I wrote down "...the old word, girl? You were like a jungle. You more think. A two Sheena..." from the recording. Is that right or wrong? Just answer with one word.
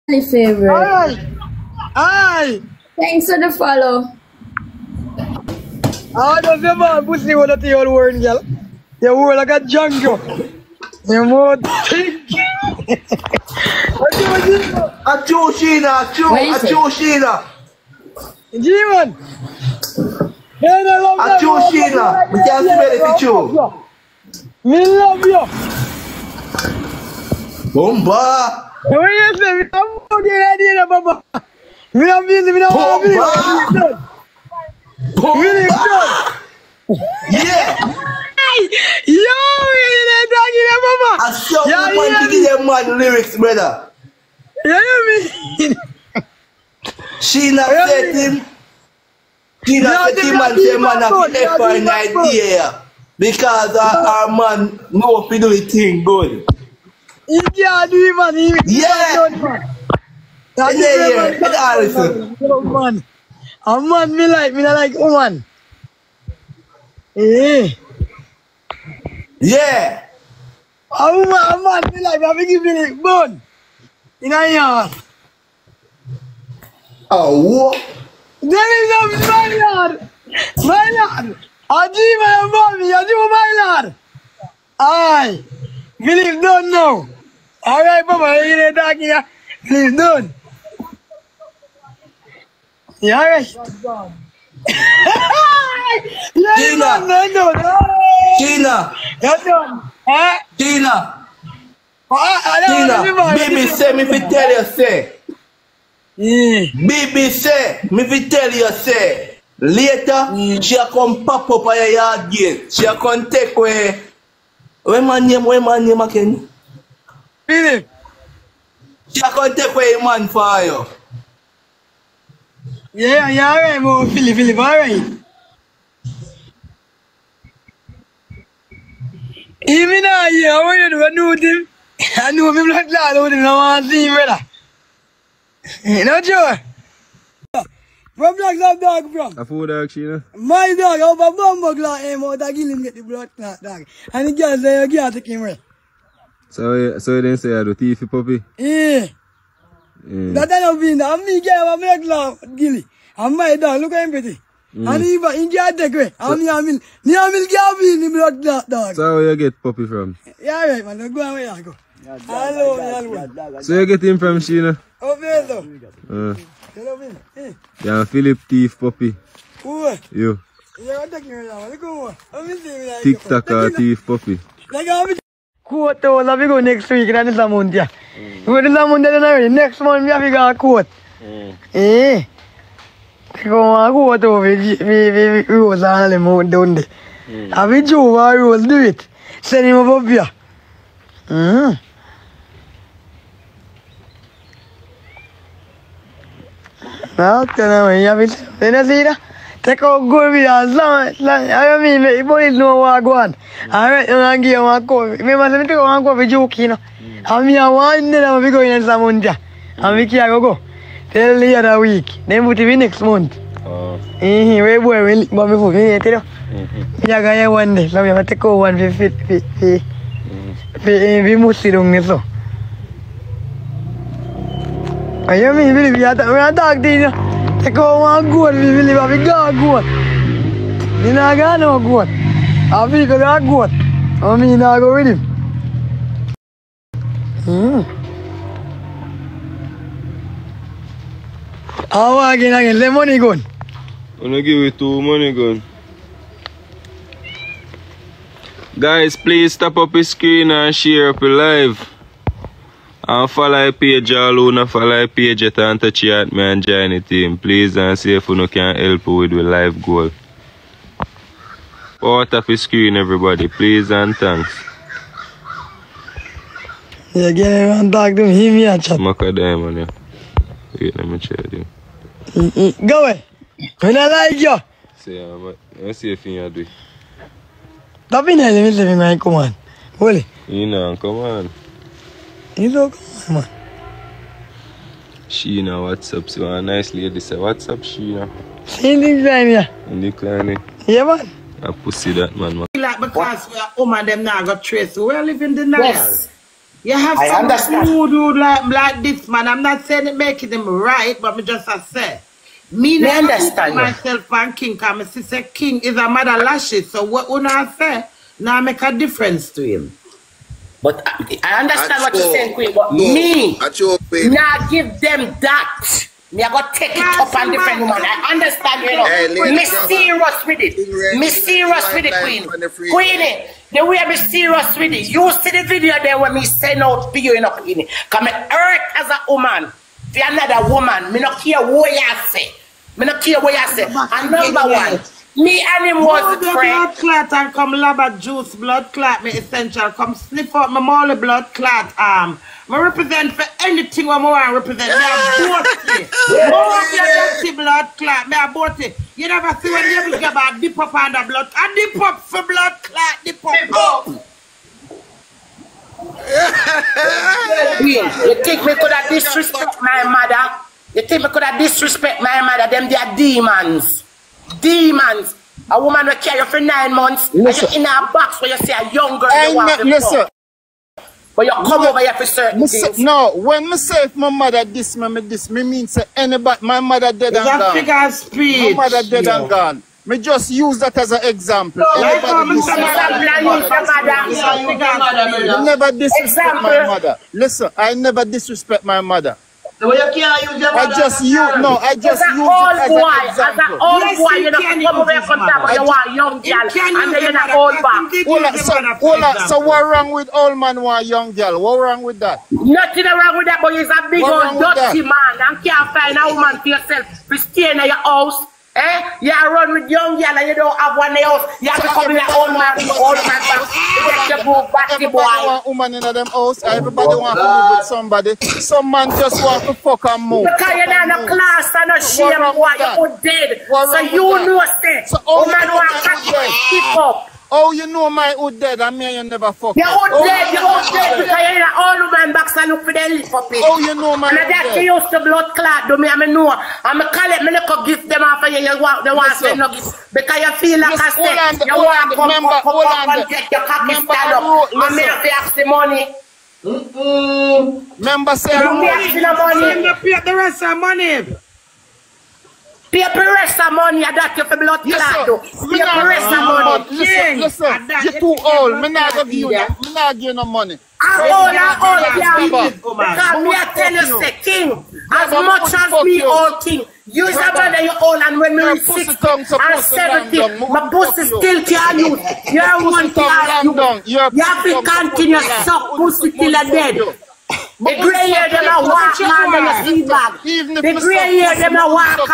right.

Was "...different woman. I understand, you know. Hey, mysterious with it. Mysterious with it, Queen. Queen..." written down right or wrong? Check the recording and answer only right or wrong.
right.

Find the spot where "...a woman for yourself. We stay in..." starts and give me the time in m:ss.
6:46.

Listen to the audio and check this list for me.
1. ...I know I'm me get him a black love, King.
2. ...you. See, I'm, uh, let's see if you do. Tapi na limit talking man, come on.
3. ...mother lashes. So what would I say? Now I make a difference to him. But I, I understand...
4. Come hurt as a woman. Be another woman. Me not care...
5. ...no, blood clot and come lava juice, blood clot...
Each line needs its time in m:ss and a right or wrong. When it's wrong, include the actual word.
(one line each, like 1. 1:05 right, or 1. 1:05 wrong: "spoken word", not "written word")
1. 2:30 wrong: "Gilly", not "King"
2. 4:34 wrong: "living", not "talking"
3. 5:06 right
4. 5:28 right
5. 5:36 right.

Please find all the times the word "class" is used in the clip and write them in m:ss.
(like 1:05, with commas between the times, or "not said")
7:01, 7:53.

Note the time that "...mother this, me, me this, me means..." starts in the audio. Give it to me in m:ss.
6:14.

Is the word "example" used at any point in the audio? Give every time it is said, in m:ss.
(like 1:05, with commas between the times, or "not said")
6:21, 6:33.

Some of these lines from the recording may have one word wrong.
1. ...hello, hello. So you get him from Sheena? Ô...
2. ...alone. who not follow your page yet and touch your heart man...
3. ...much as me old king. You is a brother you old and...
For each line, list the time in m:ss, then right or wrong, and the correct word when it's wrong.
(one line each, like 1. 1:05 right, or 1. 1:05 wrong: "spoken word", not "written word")
1. 2:42 right
2. 4:14 right
3. 7:45 right.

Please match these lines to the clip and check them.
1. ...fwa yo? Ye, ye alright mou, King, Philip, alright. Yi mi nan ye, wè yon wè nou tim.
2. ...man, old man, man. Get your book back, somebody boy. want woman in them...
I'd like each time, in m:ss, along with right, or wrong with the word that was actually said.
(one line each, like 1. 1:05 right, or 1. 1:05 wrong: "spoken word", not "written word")
1. 2:00 wrong: "Philip", not "King"
2. 6:52 wrong: "everybody", not "somebody".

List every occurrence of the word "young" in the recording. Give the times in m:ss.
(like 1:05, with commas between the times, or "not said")
6:08, 6:36, 6:41, 6:49.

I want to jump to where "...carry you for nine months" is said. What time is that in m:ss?
6:06.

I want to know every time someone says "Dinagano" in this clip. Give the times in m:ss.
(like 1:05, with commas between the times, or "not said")
3:51.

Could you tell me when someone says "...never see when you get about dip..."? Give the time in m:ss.
5:49.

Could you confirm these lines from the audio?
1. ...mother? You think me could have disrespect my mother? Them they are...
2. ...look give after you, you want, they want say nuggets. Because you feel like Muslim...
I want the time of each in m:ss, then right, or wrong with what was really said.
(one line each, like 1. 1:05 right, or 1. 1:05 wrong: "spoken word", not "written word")
1. 6:00 right
2. 7:17 wrong: "Miss", not "Muslim".